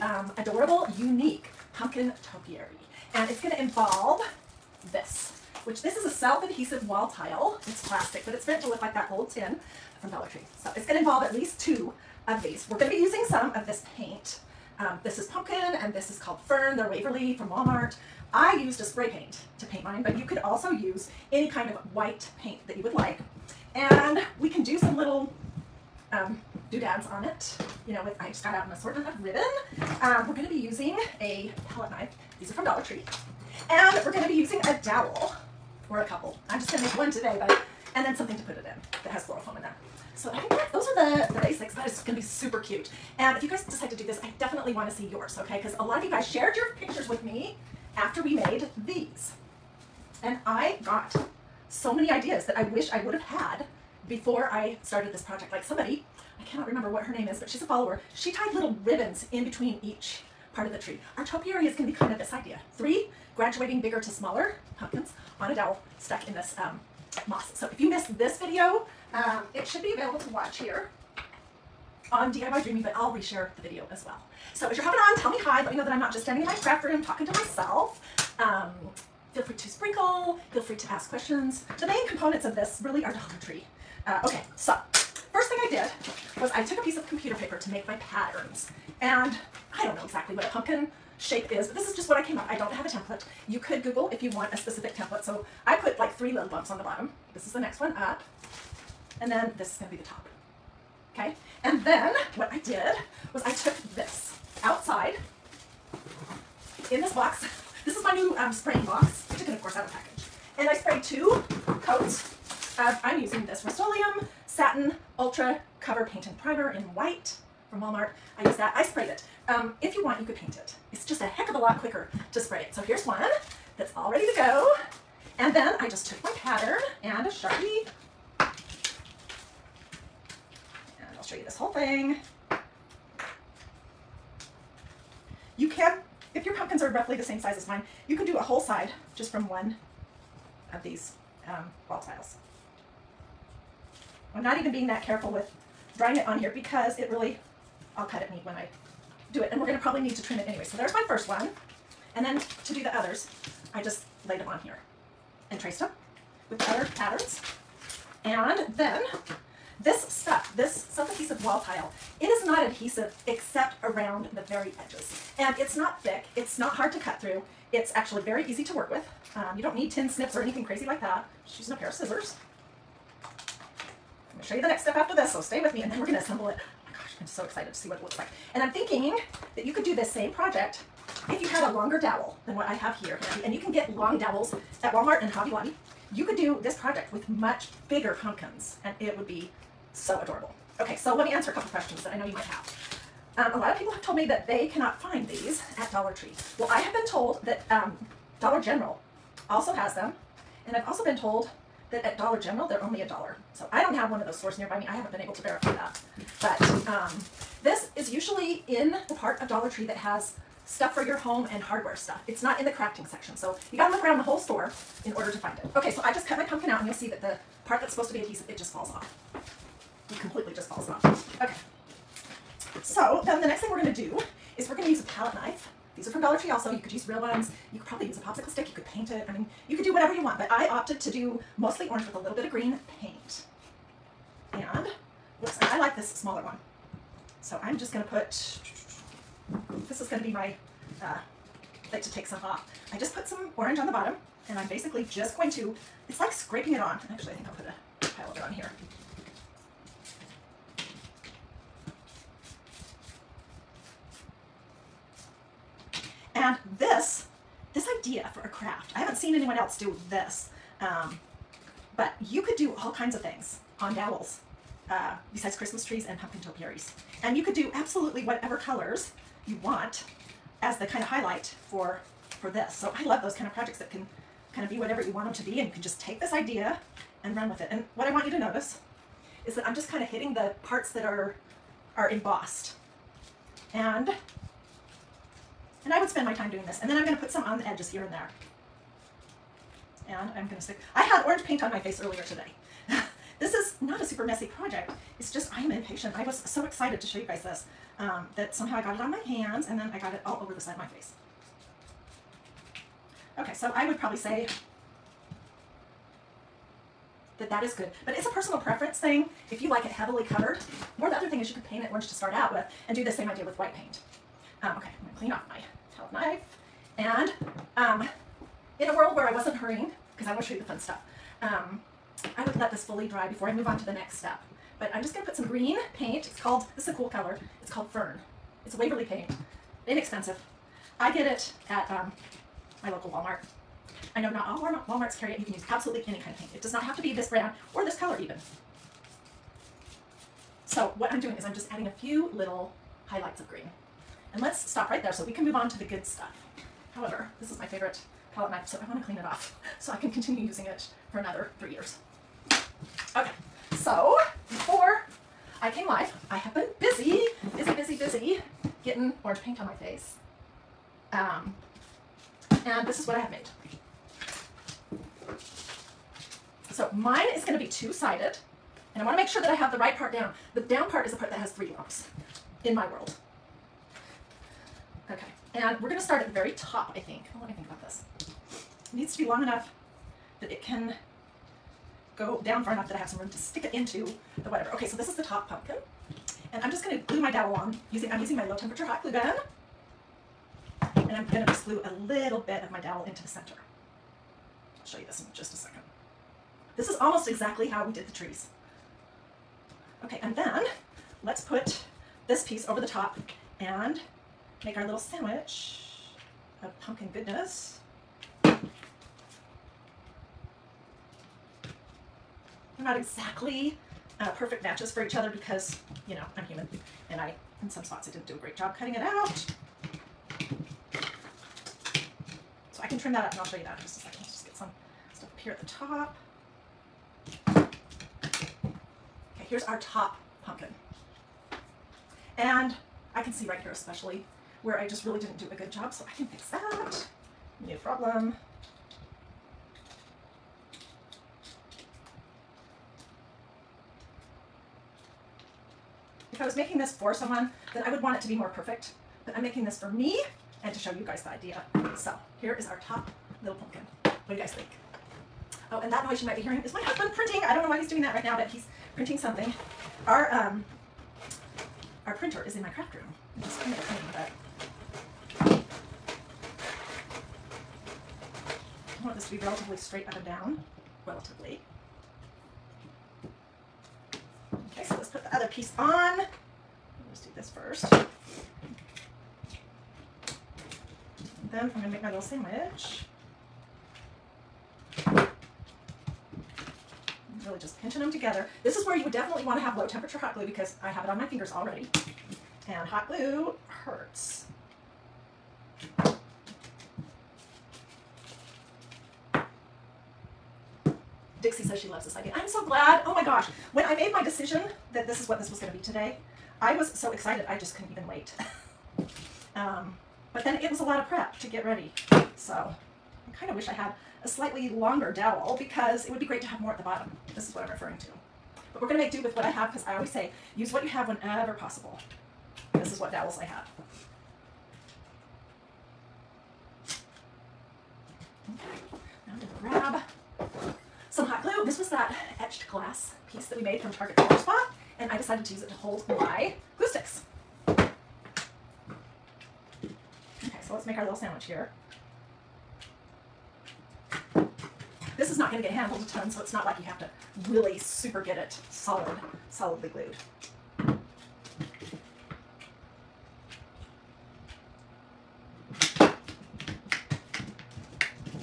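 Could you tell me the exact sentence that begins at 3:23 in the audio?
So I don't have one of those stores nearby me.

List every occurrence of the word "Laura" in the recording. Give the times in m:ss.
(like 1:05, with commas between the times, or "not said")
not said.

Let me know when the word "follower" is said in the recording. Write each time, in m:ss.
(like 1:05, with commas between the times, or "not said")
0:57.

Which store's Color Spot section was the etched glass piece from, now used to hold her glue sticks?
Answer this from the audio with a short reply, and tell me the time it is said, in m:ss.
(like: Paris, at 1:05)
Target, at 8:53.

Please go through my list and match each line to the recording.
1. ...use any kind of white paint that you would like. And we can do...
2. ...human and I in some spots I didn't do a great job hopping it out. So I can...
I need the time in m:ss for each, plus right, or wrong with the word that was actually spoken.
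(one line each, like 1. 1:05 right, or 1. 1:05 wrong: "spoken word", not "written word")
1. 0:20 right
2. 6:56 wrong: "cutting", not "hopping".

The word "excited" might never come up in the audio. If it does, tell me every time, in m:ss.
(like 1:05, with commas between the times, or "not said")
2:57, 4:56, 8:27.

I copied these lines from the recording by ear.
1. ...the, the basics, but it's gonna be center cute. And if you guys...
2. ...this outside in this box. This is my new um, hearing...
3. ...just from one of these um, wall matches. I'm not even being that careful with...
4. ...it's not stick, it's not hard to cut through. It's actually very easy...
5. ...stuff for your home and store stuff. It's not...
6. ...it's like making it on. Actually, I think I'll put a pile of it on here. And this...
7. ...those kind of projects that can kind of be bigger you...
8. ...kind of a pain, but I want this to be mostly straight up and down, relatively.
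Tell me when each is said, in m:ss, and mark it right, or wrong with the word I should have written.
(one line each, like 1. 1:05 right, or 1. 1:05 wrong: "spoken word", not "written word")
1. 0:40 wrong: "super", not "center"
2. 1:43 wrong: "spraying", not "hearing"
3. 2:19 wrong: "tiles", not "matches"
4. 2:45 wrong: "thick", not "stick"
5. 3:30 wrong: "hardware", not "store"
6. 4:06 wrong: "scraping", not "making"
7. 4:33 wrong: "whatever", not "bigger"
8. 7:43 wrong: "relatively", not "mostly".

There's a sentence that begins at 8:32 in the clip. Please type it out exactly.
So I kind of wish I had a slightly longer dowel because it would be great to have more at the bottom.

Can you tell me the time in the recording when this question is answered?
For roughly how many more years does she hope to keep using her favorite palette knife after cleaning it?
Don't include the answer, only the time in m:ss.
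5:51.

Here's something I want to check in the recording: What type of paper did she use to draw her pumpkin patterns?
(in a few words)
computer paper.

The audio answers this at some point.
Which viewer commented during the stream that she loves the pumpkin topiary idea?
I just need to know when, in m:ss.
8:21.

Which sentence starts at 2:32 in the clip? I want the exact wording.
And then to do the others, I just laid them on here and traced them with other patterns.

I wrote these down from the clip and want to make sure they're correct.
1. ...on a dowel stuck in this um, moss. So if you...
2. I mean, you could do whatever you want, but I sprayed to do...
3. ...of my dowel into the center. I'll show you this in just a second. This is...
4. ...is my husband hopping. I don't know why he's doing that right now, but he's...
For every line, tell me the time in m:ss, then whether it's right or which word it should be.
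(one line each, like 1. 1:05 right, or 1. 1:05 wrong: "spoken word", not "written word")
1. 1:05 right
2. 3:49 wrong: "opted", not "sprayed"
3. 6:32 right
4. 7:36 wrong: "printing", not "hopping".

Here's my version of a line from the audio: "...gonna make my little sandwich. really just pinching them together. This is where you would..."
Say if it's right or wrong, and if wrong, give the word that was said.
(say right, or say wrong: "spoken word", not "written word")
right.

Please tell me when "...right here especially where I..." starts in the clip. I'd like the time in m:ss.
7:13.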